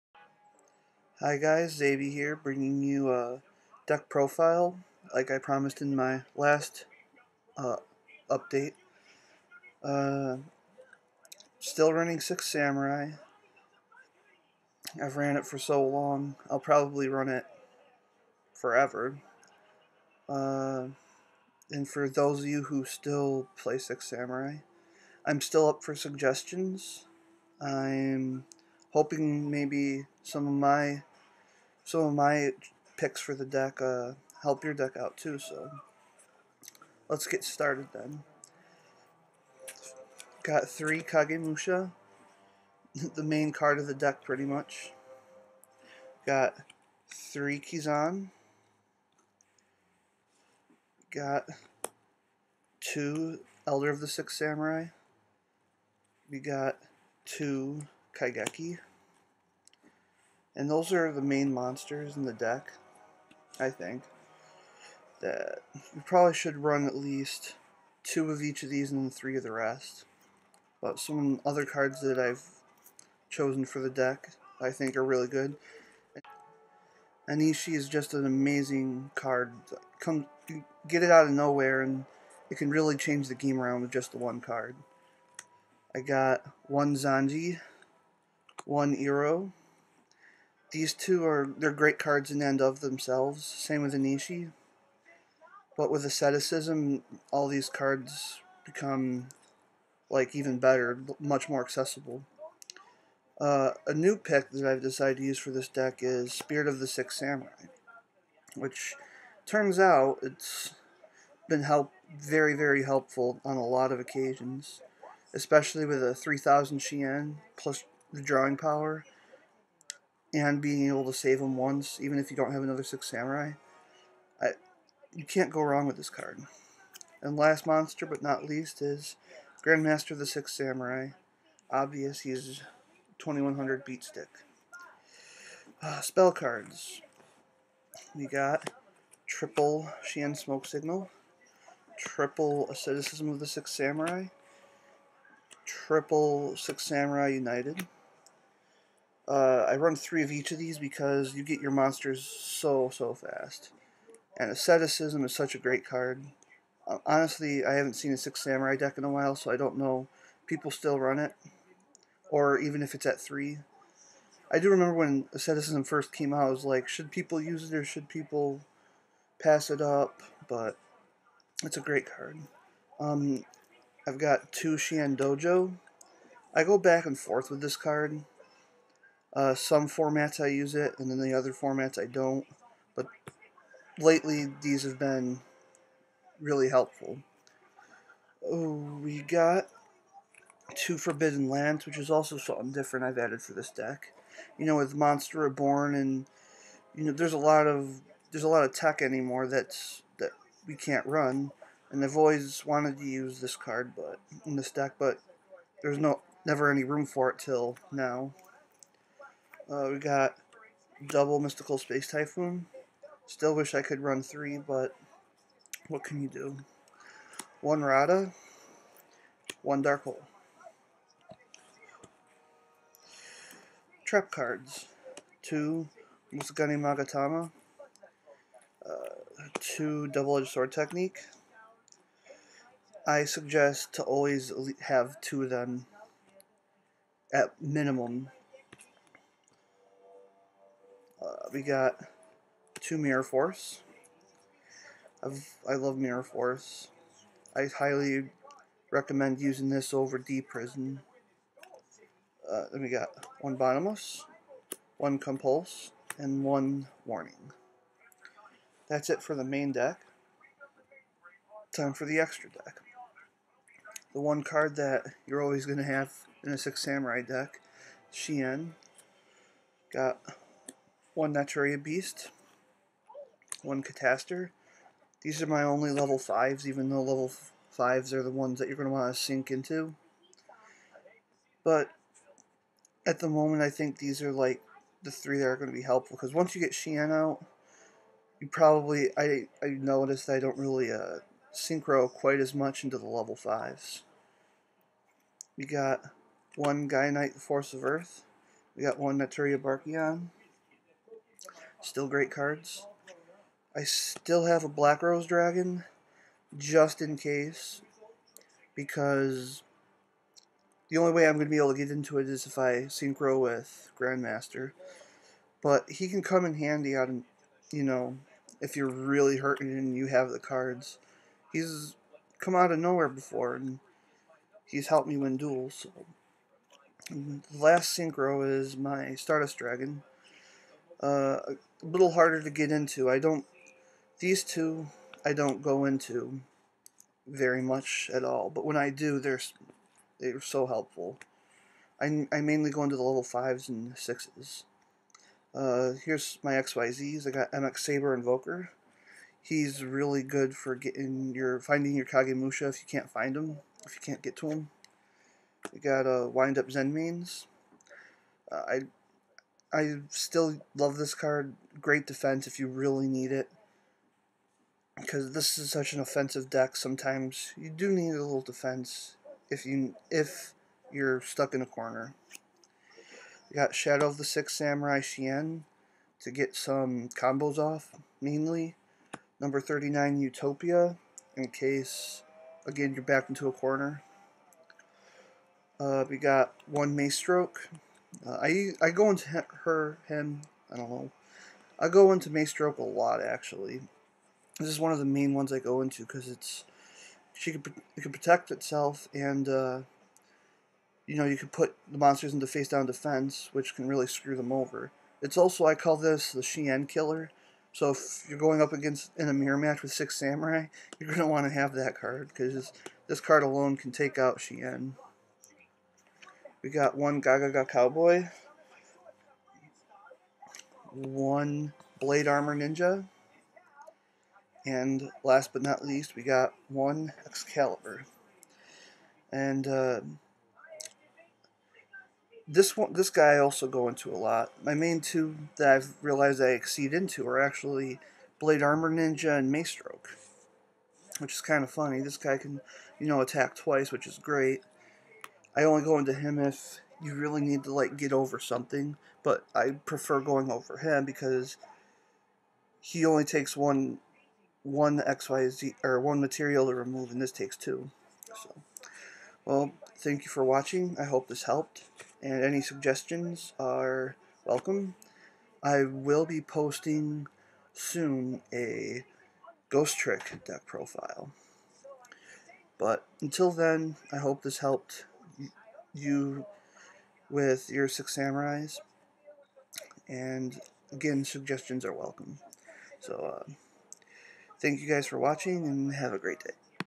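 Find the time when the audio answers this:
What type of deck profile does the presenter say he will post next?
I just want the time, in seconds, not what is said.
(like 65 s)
469 s.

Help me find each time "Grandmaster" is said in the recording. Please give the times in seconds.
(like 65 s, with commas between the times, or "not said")
129 s, 313 s.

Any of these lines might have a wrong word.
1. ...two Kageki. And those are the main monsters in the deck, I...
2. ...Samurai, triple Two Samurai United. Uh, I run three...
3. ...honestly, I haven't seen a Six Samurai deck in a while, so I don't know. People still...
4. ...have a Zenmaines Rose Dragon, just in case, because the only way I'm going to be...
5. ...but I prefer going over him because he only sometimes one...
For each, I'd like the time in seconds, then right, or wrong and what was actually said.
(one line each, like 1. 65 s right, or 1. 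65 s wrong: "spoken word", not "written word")
1. 57 s right
2. 143 s wrong: "Six", not "Two"
3. 157 s right
4. 304 s wrong: "Black", not "Zenmaines"
5. 449 s wrong: "takes", not "sometimes".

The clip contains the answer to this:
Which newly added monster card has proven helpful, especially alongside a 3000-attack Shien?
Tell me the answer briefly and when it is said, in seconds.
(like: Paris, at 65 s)
Spirit of the Six Samurai, at 106 s.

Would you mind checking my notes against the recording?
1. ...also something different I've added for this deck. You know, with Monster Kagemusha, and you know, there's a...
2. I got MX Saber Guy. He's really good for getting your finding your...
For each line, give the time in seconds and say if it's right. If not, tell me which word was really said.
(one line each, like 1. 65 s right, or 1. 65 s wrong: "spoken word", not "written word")
1. 192 s wrong: "Reborn", not "Kagemusha"
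2. 347 s wrong: "Invoker", not "Guy".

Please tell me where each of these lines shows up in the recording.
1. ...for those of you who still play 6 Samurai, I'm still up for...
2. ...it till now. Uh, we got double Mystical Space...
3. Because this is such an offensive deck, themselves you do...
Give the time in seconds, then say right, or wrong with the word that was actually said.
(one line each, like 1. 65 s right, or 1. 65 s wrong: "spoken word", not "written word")
1. 21 s right
2. 207 s right
3. 364 s wrong: "sometimes", not "themselves".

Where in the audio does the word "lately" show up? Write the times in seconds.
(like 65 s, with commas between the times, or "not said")
183 s.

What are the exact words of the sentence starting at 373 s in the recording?
we got Shadow of the Six Samurai Shien to get some combos off, mainly.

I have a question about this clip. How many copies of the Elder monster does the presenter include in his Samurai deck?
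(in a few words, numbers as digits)
2.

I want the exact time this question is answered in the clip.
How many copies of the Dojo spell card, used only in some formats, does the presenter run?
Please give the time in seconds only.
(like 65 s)
174 s.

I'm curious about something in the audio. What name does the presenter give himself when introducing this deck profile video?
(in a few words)
Xavi.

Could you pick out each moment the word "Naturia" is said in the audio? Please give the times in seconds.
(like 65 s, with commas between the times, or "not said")
271 s, 299 s.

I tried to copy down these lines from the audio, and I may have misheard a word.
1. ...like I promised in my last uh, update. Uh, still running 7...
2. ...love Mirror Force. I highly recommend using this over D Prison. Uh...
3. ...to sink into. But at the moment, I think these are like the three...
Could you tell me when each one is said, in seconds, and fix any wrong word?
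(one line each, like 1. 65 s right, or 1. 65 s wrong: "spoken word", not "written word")
1. 5 s wrong: "6", not "7"
2. 245 s right
3. 279 s right.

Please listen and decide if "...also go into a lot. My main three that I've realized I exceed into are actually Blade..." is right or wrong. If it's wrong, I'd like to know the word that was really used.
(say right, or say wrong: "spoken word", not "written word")
wrong: "two", not "three".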